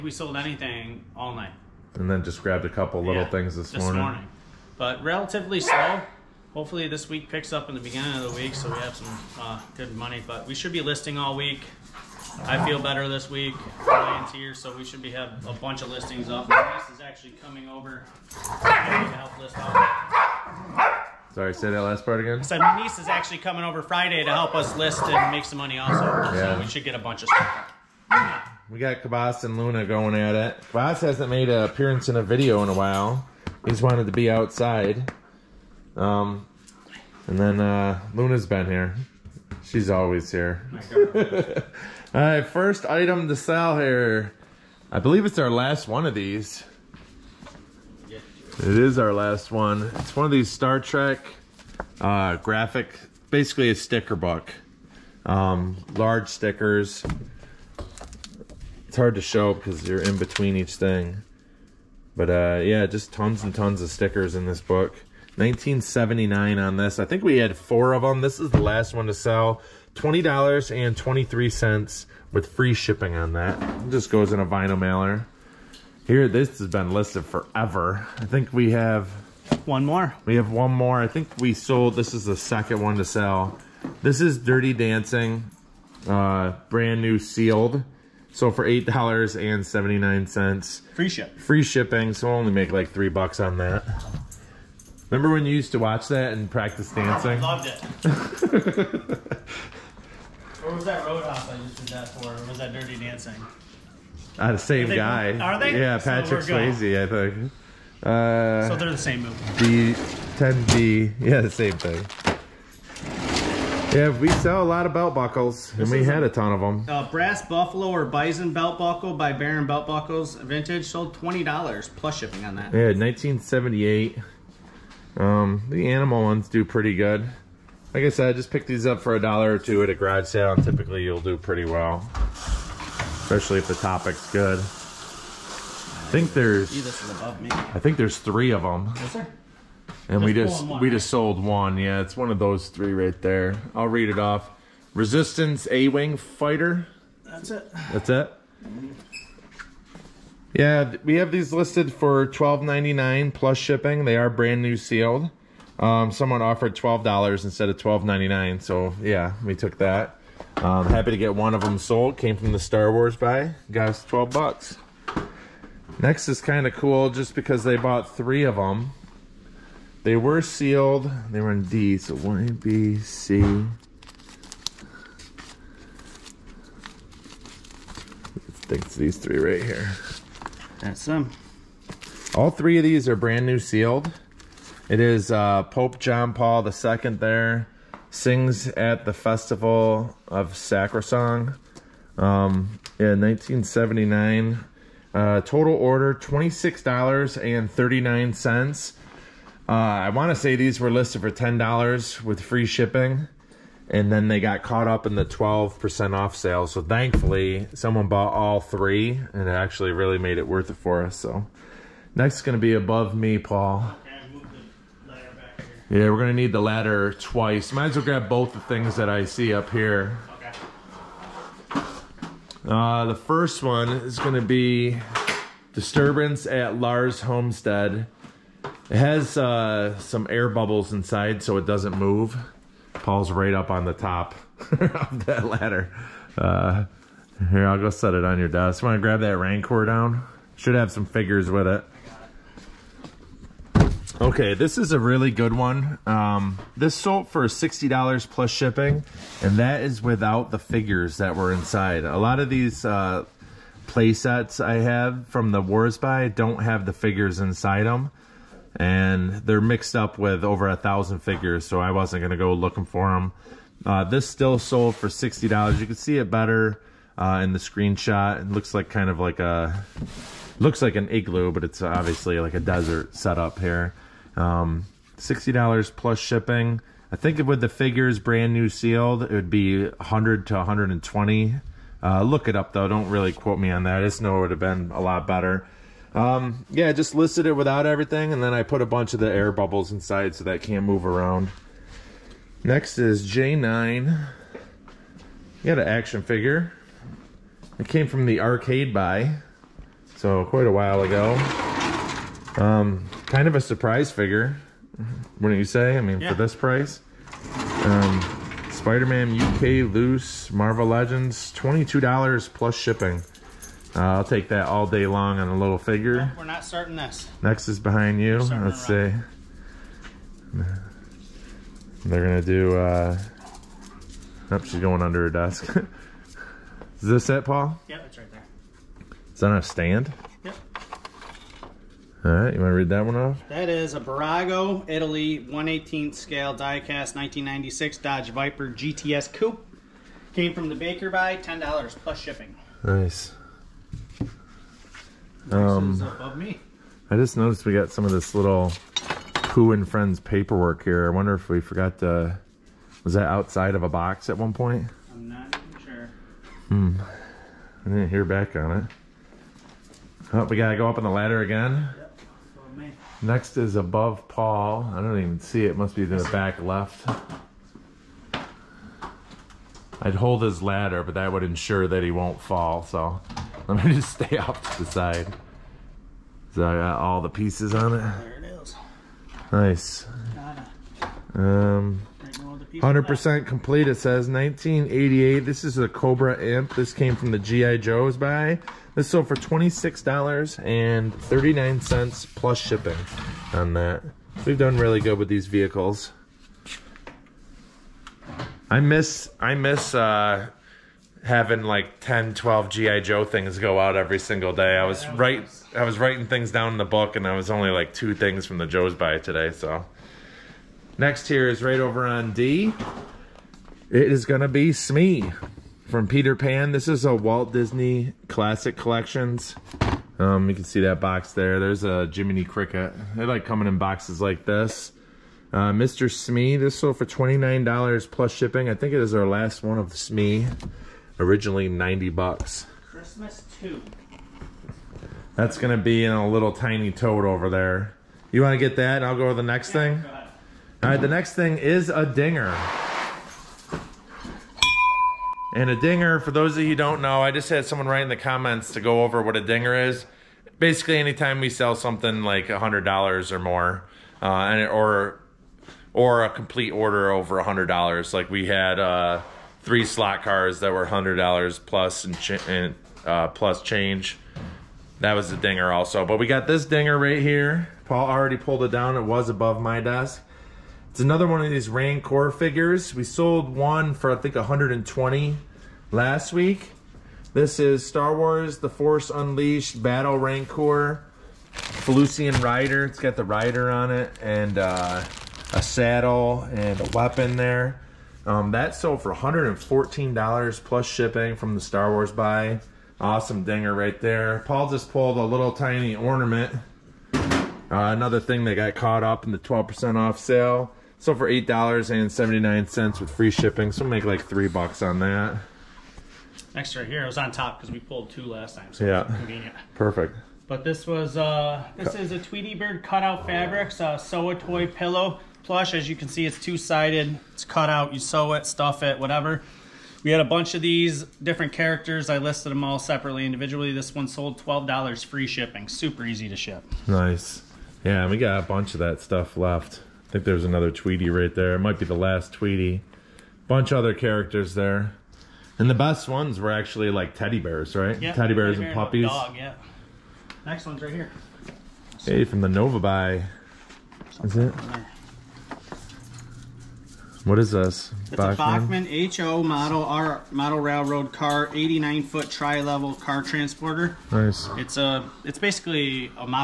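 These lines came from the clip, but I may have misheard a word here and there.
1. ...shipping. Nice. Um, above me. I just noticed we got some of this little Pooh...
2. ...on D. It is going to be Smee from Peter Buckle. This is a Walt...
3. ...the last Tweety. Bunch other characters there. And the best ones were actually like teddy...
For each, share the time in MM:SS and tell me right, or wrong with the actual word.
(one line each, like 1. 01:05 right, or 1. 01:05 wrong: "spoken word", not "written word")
1. 05:42 right
2. 06:52 wrong: "Pan", not "Buckle"
3. 08:51 right.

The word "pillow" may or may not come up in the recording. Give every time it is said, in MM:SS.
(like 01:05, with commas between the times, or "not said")
08:34.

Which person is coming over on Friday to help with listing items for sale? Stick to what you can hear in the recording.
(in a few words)
My niece.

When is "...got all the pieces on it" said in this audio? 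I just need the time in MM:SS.
06:16.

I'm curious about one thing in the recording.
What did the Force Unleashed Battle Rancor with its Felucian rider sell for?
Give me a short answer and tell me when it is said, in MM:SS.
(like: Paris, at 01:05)
$114, at 08:09.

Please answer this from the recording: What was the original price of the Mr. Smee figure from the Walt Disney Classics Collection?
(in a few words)
$90.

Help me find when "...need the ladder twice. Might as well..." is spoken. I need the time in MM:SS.
03:36.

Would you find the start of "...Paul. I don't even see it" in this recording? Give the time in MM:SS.
06:04.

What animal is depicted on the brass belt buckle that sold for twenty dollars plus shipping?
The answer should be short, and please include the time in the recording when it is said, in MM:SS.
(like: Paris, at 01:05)
Buffalo or Bison, at 01:57.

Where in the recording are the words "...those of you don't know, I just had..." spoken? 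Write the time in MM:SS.
07:26.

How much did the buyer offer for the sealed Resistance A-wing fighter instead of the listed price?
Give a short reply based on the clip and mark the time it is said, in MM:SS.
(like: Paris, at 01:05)
$12, at 02:36.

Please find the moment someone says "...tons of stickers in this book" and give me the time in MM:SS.
01:03.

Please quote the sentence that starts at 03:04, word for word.
It is uh, Pope John Paul II there sings at the Festival of Sacrosong um, in 1979.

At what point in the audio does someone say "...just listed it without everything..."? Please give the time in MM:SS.
04:46.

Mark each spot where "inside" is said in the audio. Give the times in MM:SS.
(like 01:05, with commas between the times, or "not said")
03:50, 04:11, 04:17, 04:49.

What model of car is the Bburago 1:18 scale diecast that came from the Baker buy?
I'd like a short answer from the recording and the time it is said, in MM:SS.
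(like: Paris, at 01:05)
1996 Dodge Viper GTS Coupe, at 05:37.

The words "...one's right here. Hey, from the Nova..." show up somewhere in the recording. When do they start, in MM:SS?
09:00.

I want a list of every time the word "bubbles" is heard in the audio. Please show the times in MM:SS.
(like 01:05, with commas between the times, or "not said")
03:50, 04:49.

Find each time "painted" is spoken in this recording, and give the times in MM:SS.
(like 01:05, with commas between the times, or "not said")
not said.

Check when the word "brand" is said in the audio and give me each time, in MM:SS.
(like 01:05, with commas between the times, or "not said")
01:26, 02:34, 03:03, 04:38.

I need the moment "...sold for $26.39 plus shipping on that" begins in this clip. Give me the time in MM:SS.
06:29.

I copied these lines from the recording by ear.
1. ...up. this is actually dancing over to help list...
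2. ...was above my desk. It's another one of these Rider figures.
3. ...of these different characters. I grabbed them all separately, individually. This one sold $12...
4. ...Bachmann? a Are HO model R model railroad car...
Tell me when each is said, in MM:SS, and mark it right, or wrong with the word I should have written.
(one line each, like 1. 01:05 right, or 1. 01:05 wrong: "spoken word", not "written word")
1. 00:16 wrong: "coming", not "dancing"
2. 07:49 wrong: "Rancor", not "Rider"
3. 08:40 wrong: "listed", not "grabbed"
4. 09:08 wrong: "Bachmann", not "Are".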